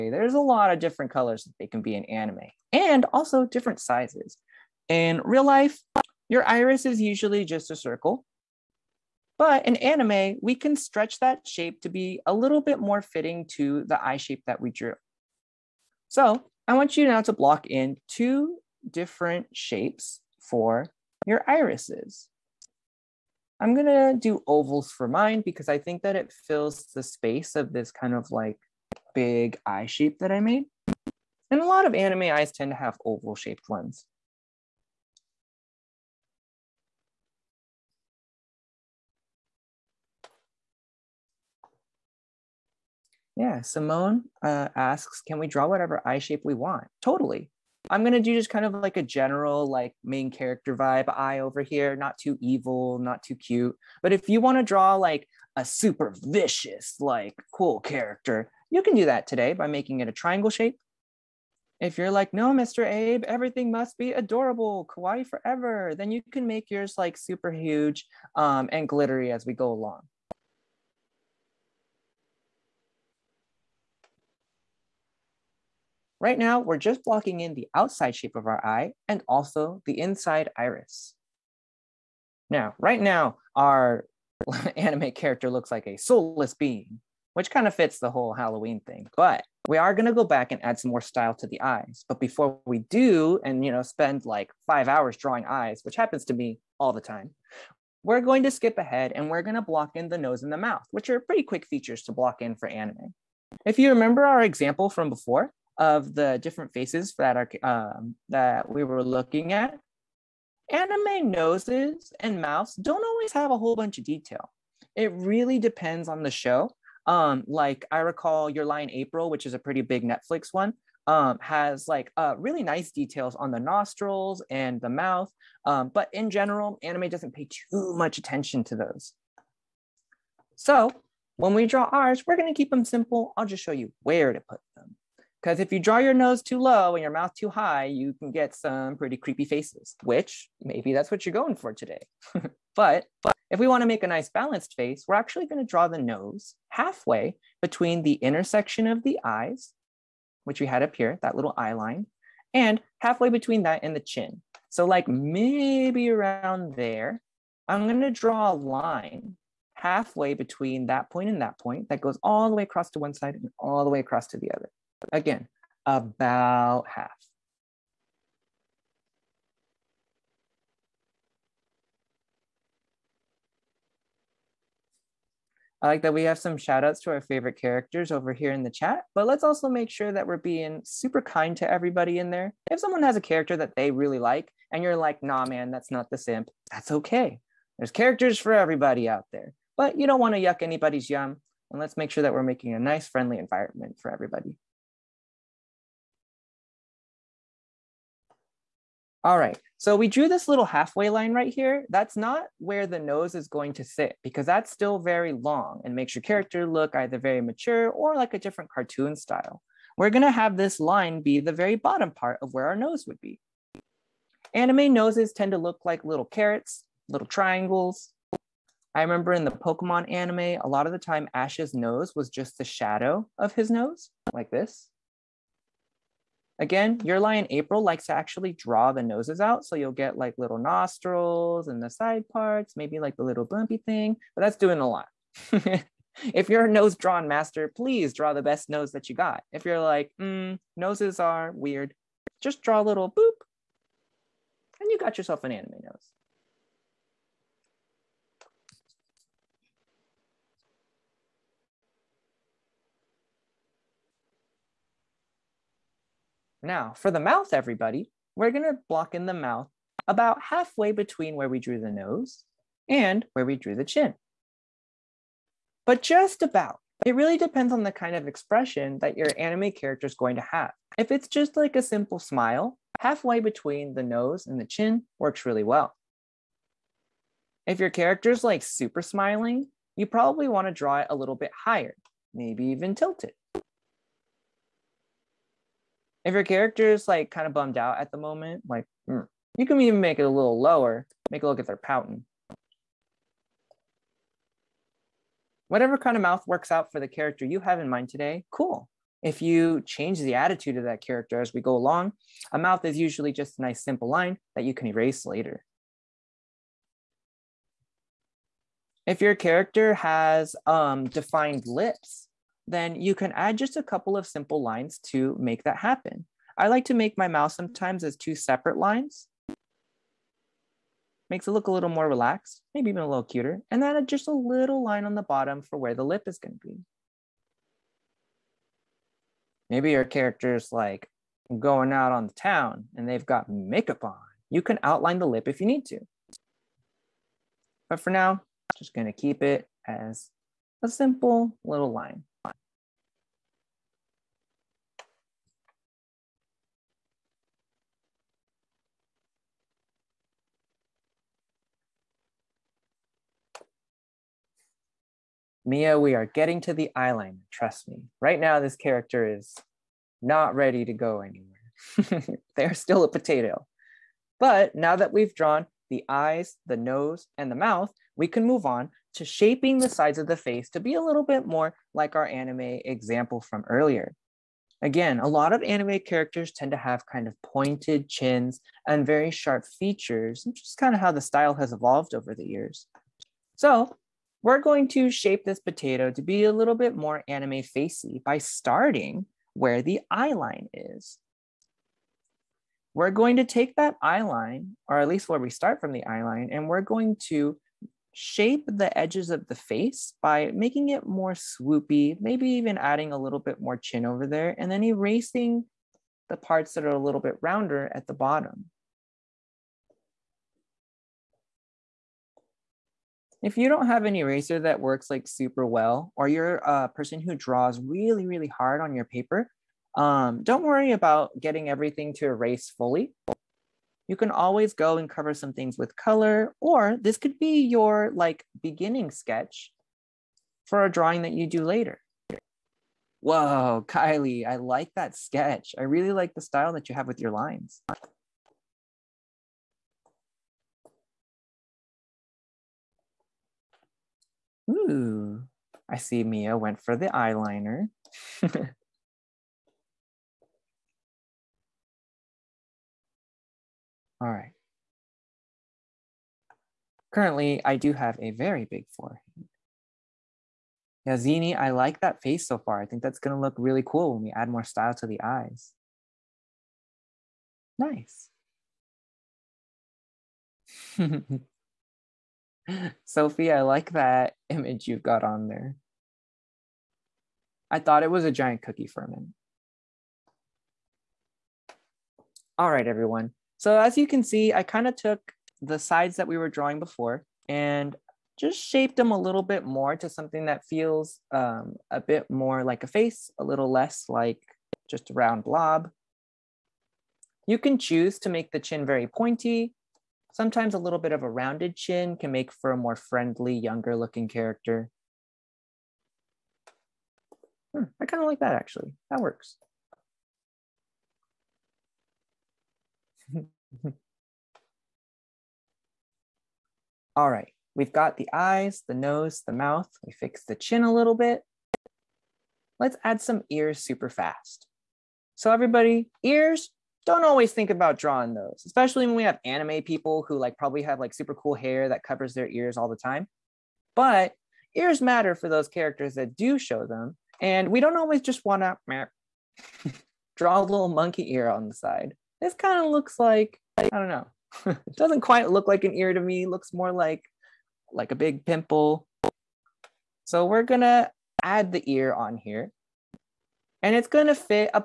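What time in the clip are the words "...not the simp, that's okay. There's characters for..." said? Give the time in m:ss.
3:05.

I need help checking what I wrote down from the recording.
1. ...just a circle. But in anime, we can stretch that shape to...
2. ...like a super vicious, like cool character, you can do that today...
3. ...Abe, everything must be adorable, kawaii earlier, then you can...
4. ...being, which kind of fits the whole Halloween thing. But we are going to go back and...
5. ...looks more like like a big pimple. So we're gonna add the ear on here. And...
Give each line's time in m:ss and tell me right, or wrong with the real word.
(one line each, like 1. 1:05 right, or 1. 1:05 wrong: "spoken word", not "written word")
1. 0:07 right
2. 0:54 right
3. 1:02 wrong: "forever", not "earlier"
4. 1:26 right
5. 9:06 right.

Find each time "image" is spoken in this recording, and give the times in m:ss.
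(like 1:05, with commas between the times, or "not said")
7:54.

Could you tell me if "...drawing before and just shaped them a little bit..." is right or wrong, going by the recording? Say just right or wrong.
right.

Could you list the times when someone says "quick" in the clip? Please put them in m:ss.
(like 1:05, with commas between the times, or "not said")
1:41.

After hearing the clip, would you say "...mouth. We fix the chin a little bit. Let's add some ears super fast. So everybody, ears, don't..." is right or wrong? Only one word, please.
right.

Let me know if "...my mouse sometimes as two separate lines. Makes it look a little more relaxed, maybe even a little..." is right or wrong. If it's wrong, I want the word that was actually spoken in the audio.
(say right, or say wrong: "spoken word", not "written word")
right.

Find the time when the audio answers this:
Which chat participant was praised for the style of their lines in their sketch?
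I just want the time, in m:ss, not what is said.
7:13.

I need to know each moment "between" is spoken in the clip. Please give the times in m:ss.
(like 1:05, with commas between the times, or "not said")
2:27, 2:33, 2:40, 4:20, 4:33.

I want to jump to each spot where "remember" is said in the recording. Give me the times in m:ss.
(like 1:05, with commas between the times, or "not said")
1:43, 3:39.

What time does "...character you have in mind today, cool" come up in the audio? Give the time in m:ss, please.
4:57.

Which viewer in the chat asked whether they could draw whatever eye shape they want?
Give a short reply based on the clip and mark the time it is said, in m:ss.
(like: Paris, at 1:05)
Simone, at 0:43.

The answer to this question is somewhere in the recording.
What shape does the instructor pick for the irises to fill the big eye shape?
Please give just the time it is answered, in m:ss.
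0:24.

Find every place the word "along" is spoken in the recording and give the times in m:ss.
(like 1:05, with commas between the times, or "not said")
1:09, 5:01.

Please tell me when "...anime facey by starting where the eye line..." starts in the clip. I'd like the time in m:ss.
6:27.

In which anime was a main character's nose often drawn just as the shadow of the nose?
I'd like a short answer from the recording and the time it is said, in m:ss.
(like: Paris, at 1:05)
Pokemon, at 3:39.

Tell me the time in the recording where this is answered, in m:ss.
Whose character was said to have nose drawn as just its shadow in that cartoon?
3:41.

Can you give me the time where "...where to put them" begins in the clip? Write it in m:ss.
2:14.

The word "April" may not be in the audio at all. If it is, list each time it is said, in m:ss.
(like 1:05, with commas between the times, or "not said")
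1:58, 3:47.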